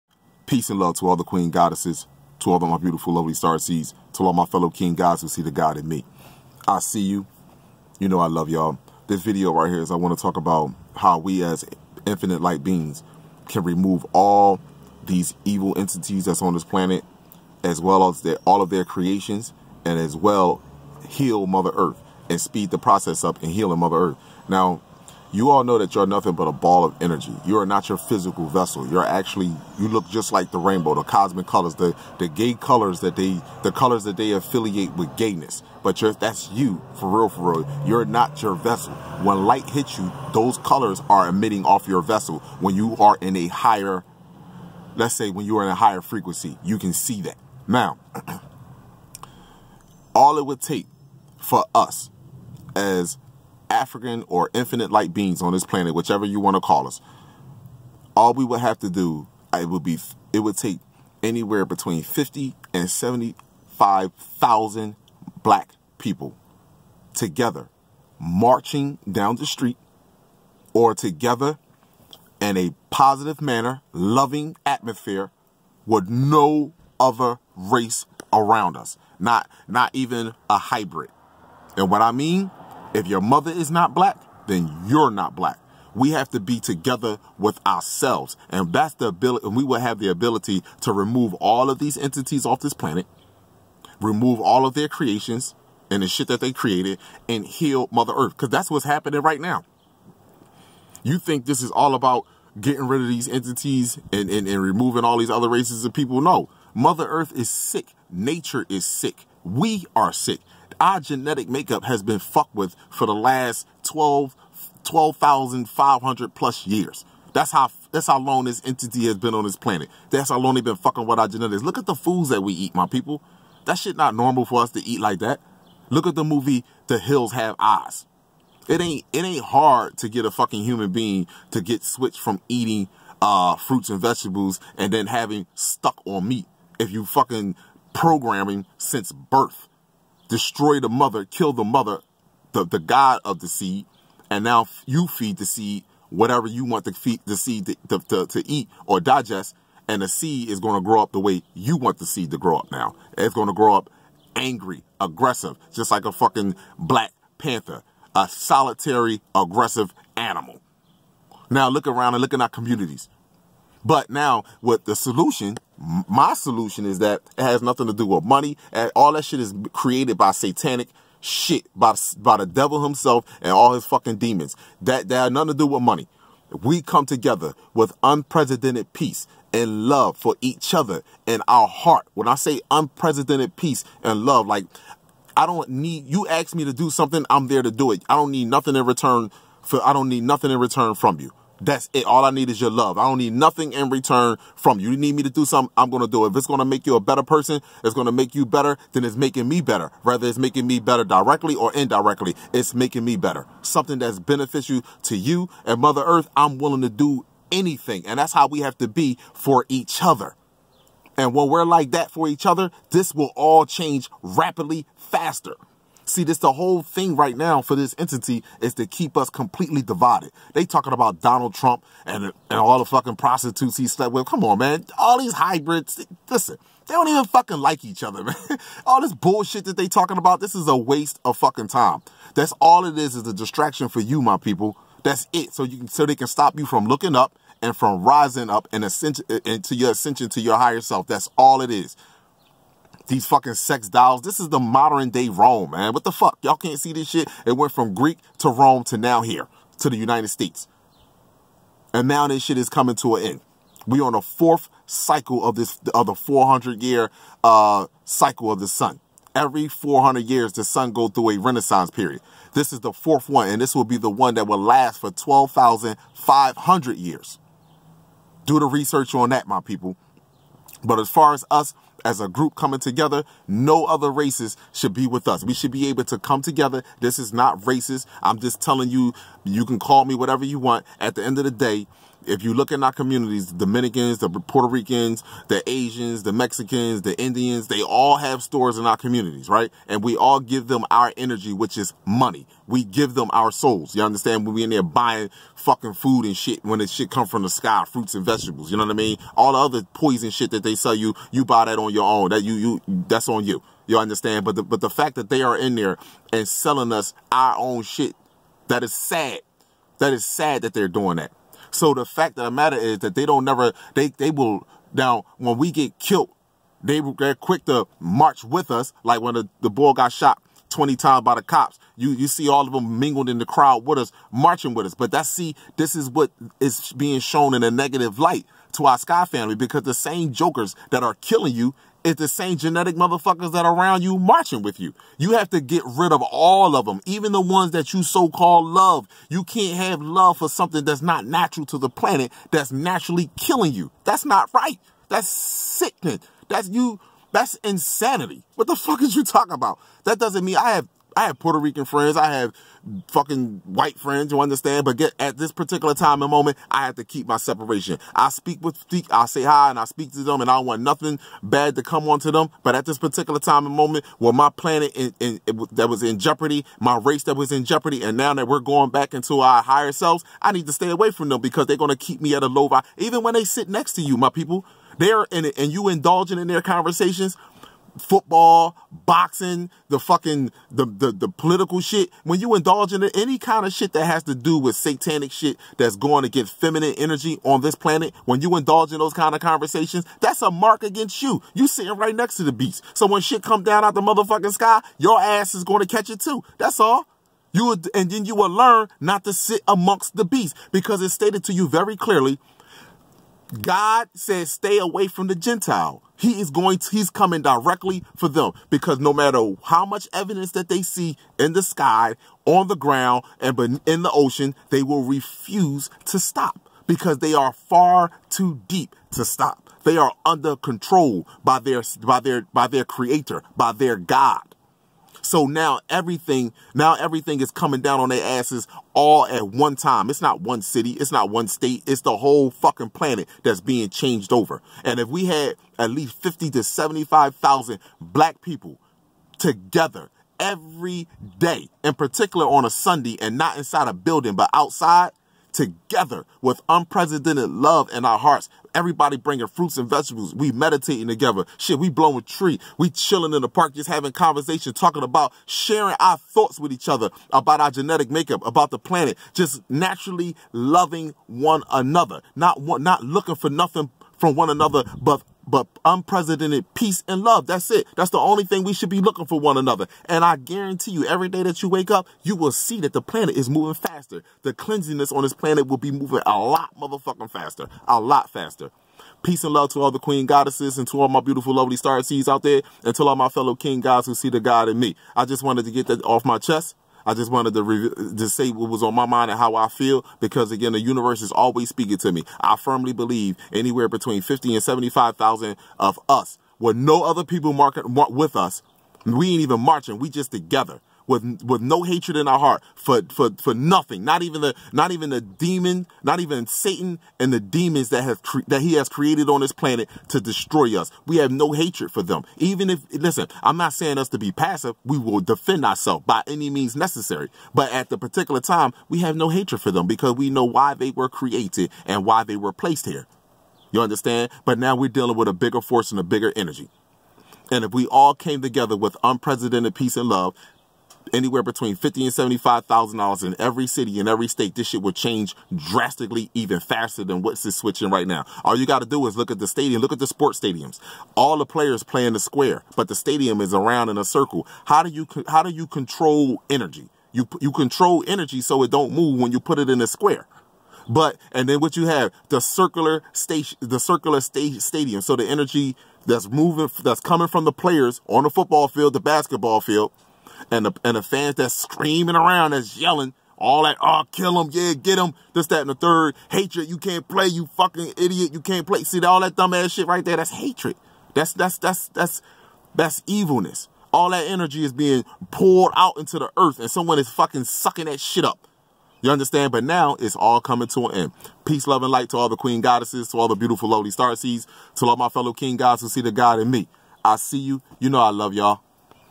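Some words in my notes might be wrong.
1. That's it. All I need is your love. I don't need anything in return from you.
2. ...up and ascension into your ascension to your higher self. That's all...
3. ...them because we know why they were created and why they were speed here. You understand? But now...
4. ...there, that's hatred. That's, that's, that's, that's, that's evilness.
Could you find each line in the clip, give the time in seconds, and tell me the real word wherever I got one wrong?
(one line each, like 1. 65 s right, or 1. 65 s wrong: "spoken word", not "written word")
1. 191 s wrong: "nothing", not "anything"
2. 238 s right
3. 519 s wrong: "placed", not "speed"
4. 570 s right.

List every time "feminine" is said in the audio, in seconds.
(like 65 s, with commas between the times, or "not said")
386 s.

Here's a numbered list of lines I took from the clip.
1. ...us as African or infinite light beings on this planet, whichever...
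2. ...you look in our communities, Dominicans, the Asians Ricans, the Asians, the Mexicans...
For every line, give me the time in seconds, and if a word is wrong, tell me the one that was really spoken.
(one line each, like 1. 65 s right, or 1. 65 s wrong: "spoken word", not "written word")
1. 51 s right
2. 282 s wrong: "Puerto", not "Asians".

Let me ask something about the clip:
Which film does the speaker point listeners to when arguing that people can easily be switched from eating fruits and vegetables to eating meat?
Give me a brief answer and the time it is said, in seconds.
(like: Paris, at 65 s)
The Hills Have Eyes, at 126 s.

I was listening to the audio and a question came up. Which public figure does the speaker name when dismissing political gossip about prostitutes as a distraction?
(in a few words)
Donald Trump.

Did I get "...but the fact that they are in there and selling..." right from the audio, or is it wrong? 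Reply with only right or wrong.
right.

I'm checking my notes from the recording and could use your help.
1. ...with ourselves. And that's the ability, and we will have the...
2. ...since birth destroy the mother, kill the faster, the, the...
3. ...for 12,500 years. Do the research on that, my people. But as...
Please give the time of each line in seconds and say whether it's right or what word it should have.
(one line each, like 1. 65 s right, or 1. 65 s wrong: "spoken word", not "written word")
1. 87 s right
2. 138 s wrong: "mother", not "faster"
3. 264 s right.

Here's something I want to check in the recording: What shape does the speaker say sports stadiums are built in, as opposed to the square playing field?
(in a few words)
A circle.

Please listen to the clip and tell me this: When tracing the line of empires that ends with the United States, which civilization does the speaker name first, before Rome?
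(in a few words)
Greek.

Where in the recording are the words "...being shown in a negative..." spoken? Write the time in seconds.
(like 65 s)
326 s.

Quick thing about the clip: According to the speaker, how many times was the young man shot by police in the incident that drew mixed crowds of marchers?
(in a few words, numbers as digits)
20.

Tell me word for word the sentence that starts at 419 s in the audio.
They are under control by their by their by their creator, by their God.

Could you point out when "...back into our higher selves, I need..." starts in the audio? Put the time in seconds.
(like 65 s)
368 s.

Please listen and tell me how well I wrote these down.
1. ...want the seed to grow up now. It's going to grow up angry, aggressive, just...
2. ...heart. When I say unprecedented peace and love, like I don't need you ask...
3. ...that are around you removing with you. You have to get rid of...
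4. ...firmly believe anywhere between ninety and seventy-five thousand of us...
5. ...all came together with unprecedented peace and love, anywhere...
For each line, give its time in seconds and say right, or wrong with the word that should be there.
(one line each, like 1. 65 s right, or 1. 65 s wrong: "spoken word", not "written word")
1. 151 s right
2. 181 s right
3. 333 s wrong: "marching", not "removing"
4. 492 s wrong: "fifty", not "ninety"
5. 527 s right.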